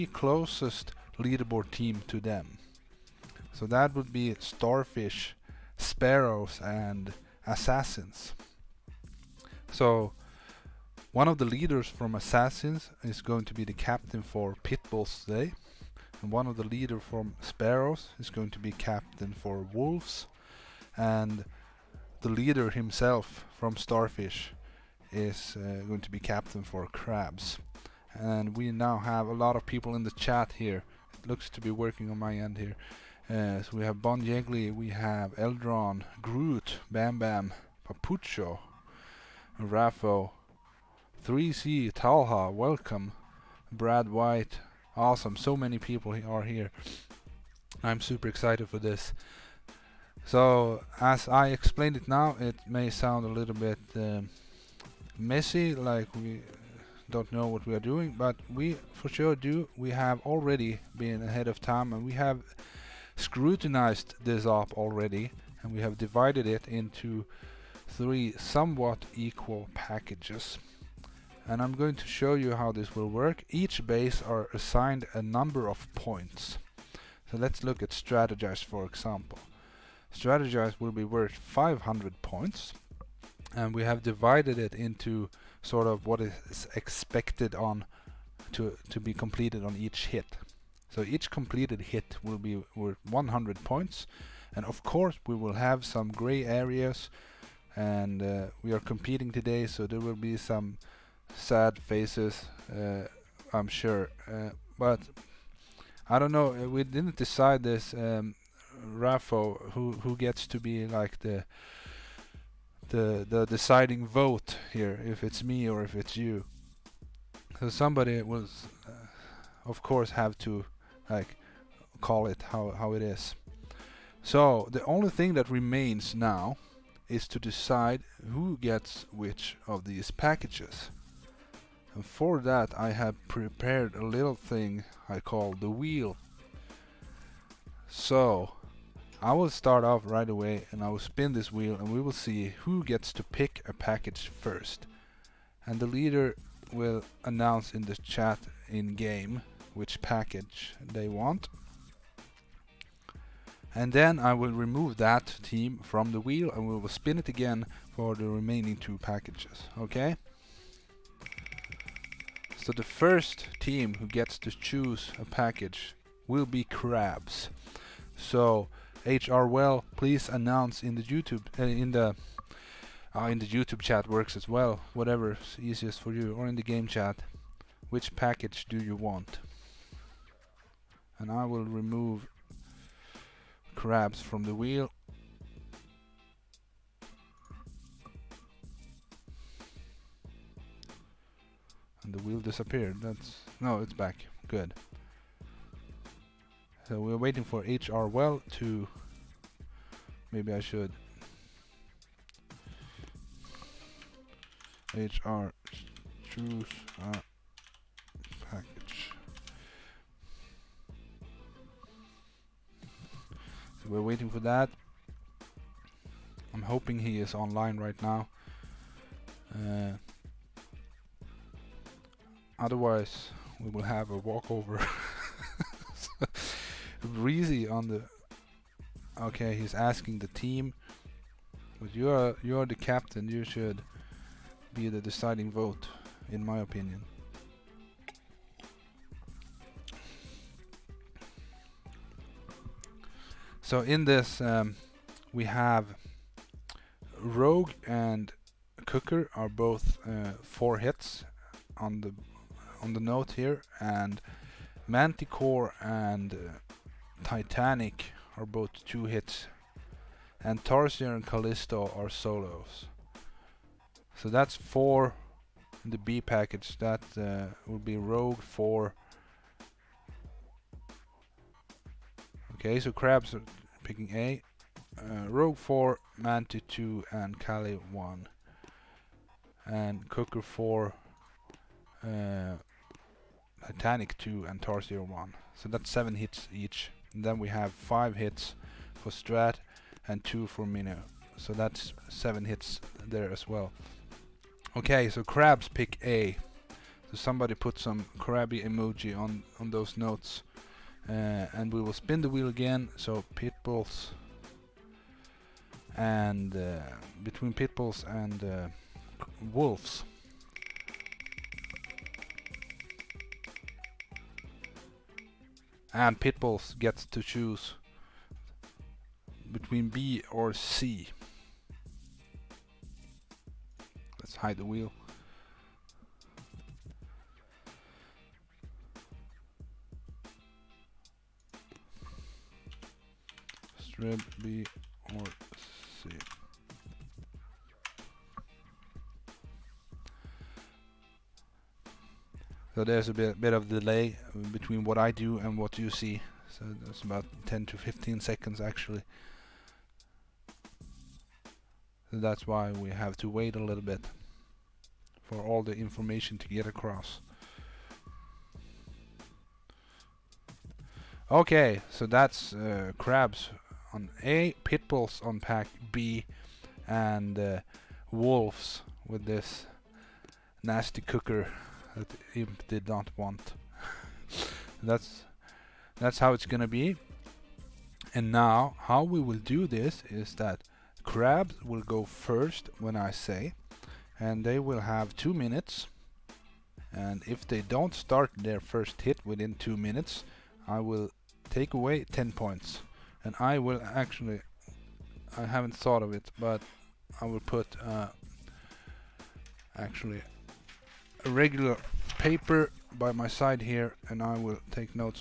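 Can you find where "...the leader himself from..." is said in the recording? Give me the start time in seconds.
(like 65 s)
22 s.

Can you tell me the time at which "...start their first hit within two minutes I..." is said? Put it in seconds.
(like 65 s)
387 s.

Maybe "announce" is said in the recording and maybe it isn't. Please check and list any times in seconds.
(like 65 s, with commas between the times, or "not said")
147 s, 170 s.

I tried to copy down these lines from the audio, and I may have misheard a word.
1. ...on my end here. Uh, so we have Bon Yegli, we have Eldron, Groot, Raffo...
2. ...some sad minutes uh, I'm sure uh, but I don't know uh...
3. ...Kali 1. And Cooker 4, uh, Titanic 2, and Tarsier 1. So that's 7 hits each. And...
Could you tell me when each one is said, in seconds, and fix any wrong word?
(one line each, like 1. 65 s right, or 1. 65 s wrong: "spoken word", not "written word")
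1. 32 s wrong: "Bam", not "Raffo"
2. 100 s wrong: "faces", not "minutes"
3. 277 s right.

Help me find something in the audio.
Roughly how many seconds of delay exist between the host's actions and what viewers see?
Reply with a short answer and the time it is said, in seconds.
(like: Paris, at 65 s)
10 to 15 seconds, at 347 s.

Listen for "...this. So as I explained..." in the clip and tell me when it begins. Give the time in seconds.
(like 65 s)
48 s.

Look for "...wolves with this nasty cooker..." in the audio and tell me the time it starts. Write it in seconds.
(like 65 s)
368 s.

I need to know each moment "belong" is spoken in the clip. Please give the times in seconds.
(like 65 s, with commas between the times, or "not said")
not said.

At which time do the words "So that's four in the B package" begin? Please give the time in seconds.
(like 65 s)
264 s.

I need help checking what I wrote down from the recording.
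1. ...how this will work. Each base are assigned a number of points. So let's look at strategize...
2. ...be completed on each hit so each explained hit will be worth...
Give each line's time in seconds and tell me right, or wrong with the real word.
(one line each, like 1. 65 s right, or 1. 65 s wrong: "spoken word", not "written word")
1. 72 s right
2. 89 s wrong: "completed", not "explained".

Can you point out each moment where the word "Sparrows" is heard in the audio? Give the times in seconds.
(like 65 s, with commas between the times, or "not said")
5 s, 17 s.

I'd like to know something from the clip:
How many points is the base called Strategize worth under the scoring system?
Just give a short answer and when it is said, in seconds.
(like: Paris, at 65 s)
500, at 81 s.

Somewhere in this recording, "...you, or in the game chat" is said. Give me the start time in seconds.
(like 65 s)
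176 s.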